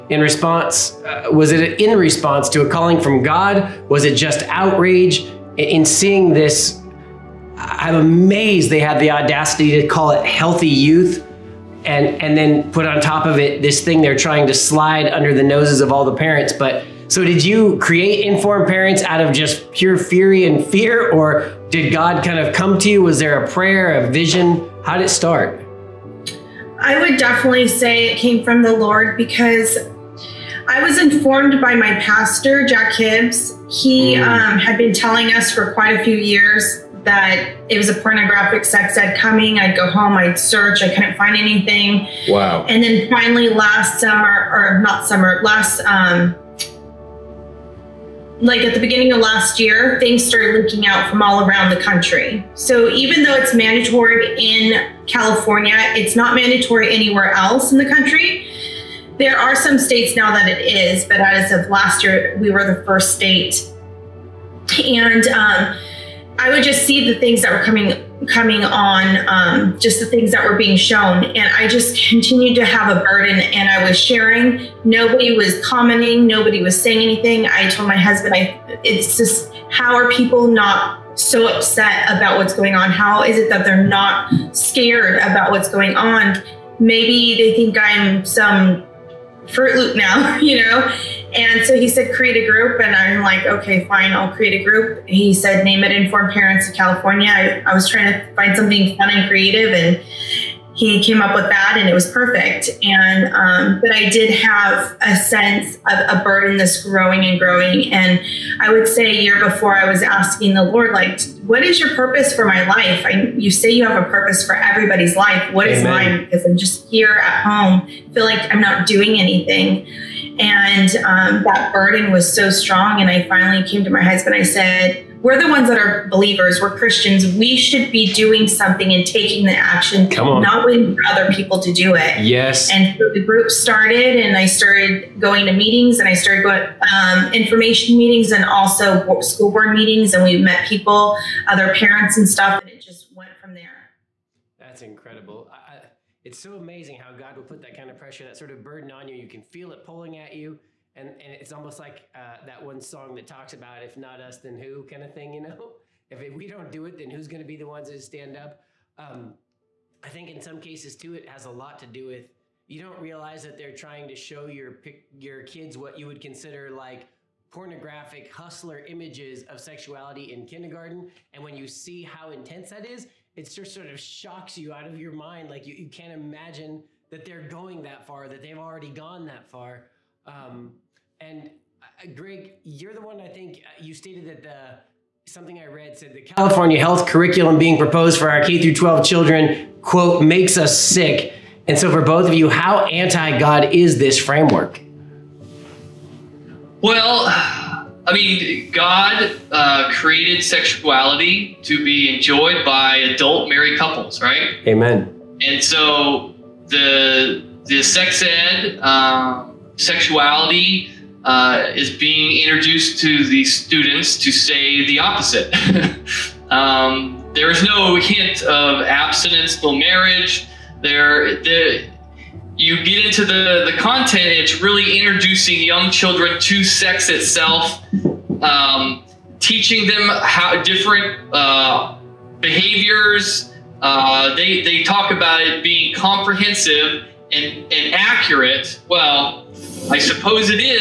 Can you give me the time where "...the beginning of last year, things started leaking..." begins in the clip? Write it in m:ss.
0:48.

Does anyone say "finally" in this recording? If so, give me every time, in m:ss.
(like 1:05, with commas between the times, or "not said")
0:43, 2:03.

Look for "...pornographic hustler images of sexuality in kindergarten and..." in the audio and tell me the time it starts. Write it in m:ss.
2:47.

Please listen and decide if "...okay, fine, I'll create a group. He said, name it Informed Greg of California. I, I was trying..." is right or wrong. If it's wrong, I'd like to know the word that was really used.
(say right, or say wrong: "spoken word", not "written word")
wrong: "Parents", not "Greg".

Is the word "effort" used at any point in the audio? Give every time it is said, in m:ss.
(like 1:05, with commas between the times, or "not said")
not said.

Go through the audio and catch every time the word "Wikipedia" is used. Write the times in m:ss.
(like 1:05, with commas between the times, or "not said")
not said.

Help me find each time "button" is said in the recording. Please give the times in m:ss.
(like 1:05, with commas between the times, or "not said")
not said.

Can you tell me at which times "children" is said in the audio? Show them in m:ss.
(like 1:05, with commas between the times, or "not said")
3:09, 3:45.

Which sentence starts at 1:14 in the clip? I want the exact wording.
Nobody was commenting, nobody was saying anything.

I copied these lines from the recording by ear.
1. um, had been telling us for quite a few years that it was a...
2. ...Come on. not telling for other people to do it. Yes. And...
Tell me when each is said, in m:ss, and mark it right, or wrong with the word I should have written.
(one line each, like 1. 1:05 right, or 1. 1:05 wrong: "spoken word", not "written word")
1. 0:34 right
2. 2:10 wrong: "waiting", not "telling".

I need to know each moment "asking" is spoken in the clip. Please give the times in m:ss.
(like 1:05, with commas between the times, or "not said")
1:50.